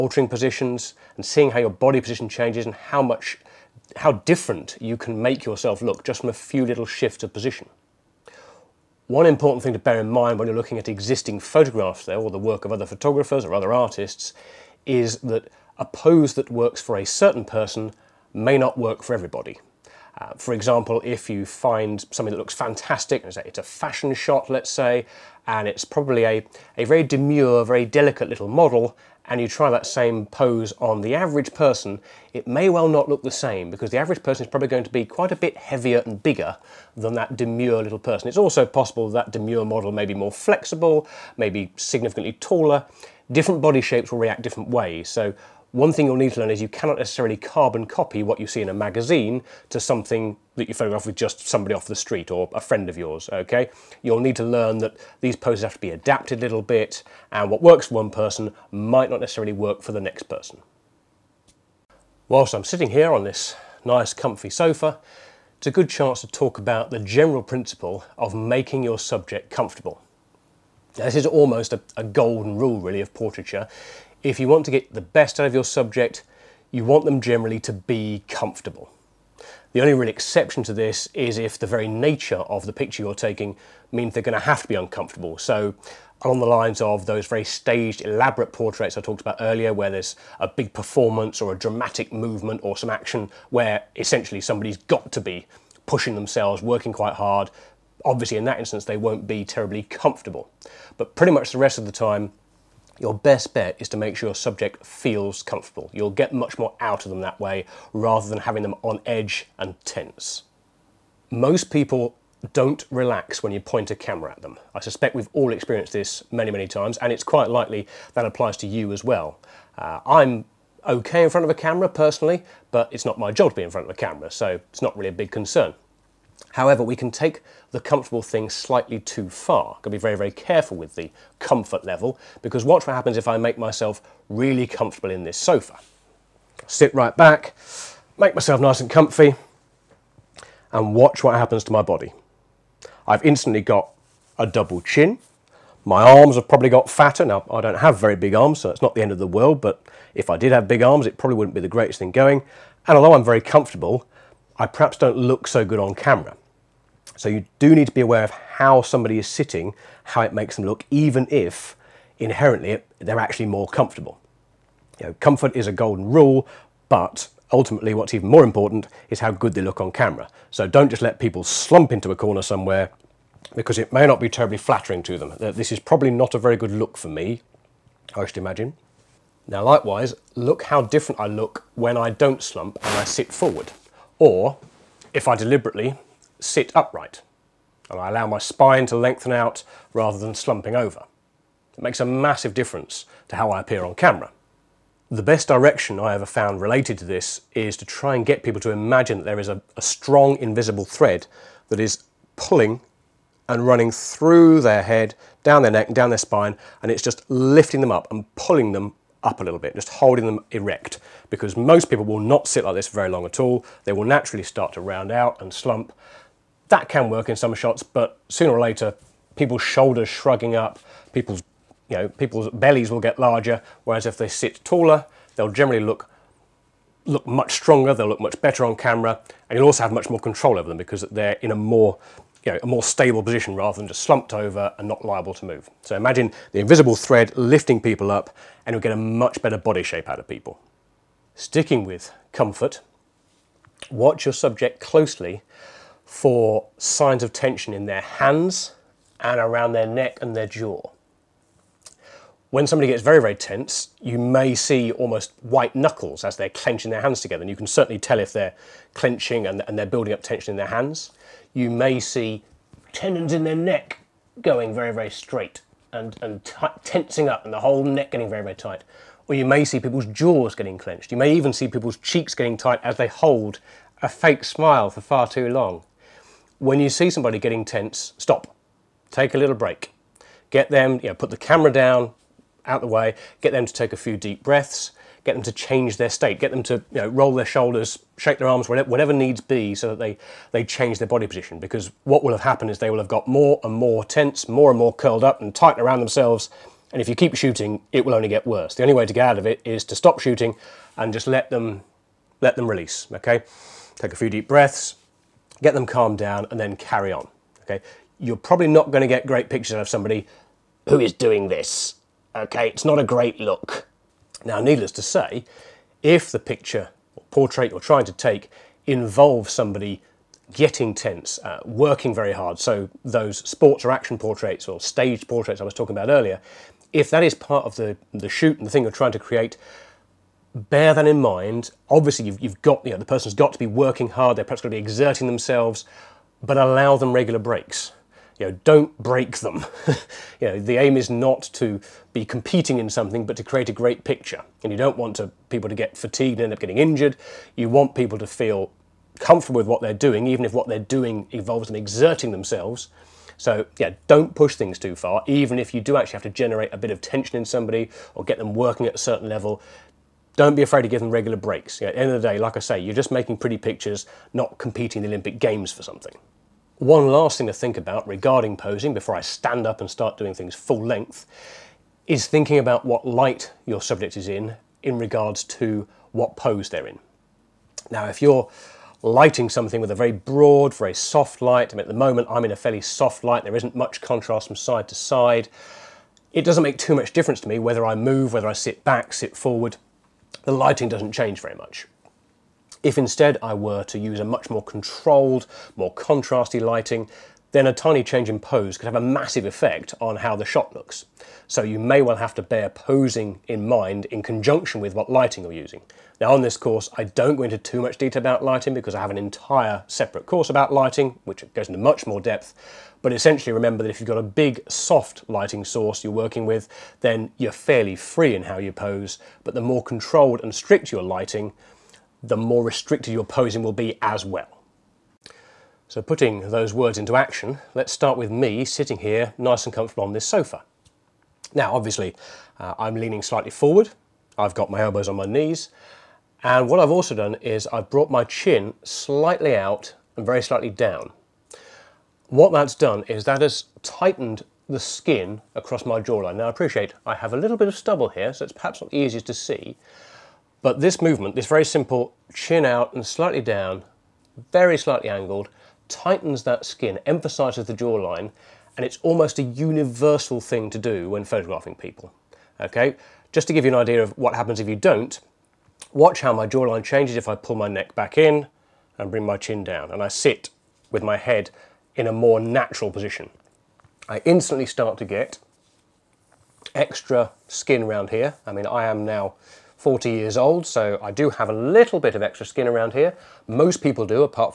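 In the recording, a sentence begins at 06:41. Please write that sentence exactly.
So you may well have to bear posing in mind in conjunction with what lighting you're using.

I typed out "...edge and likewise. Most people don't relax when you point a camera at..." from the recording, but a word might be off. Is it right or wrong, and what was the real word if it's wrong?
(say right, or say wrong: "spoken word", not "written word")
wrong: "tense", not "likewise".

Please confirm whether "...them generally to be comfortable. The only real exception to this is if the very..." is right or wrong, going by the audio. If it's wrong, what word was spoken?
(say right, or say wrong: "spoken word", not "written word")
right.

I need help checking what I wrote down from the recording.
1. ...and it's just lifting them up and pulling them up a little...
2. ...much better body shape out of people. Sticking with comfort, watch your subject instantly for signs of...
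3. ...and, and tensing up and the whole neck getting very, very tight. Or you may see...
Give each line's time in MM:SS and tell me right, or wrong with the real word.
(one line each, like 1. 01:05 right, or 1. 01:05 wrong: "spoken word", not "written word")
1. 03:26 right
2. 03:58 wrong: "closely", not "instantly"
3. 04:25 right.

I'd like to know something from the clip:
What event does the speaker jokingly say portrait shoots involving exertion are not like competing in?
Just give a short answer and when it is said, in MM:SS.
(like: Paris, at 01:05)
Olympic Games, at 06:05.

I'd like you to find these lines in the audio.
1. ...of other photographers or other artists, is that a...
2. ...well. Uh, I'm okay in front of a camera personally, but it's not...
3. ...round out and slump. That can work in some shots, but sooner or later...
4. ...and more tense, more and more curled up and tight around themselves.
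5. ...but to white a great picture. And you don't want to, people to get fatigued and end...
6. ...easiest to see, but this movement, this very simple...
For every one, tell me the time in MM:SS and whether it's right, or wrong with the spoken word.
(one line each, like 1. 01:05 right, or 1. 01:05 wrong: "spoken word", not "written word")
1. 00:12 right
2. 01:59 right
3. 03:34 right
4. 04:53 right
5. 05:43 wrong: "create", not "white"
6. 07:28 right.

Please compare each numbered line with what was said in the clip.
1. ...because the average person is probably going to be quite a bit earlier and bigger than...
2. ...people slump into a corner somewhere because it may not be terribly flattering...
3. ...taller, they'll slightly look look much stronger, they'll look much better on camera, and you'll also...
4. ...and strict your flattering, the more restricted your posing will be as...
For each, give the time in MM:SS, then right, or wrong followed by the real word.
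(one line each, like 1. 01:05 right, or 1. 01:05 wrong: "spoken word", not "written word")
1. 00:33 wrong: "heavier", not "earlier"
2. 02:51 right
3. 03:44 wrong: "generally", not "slightly"
4. 07:00 wrong: "lighting", not "flattering".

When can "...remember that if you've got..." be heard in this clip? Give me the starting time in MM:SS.
06:53.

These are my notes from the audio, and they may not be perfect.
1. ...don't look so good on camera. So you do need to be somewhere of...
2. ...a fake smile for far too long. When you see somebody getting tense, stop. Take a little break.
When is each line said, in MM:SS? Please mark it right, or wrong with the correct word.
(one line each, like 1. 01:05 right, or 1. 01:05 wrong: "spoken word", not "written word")
1. 02:34 wrong: "aware", not "somewhere"
2. 04:34 right.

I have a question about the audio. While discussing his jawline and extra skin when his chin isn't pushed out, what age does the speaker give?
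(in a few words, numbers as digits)
40.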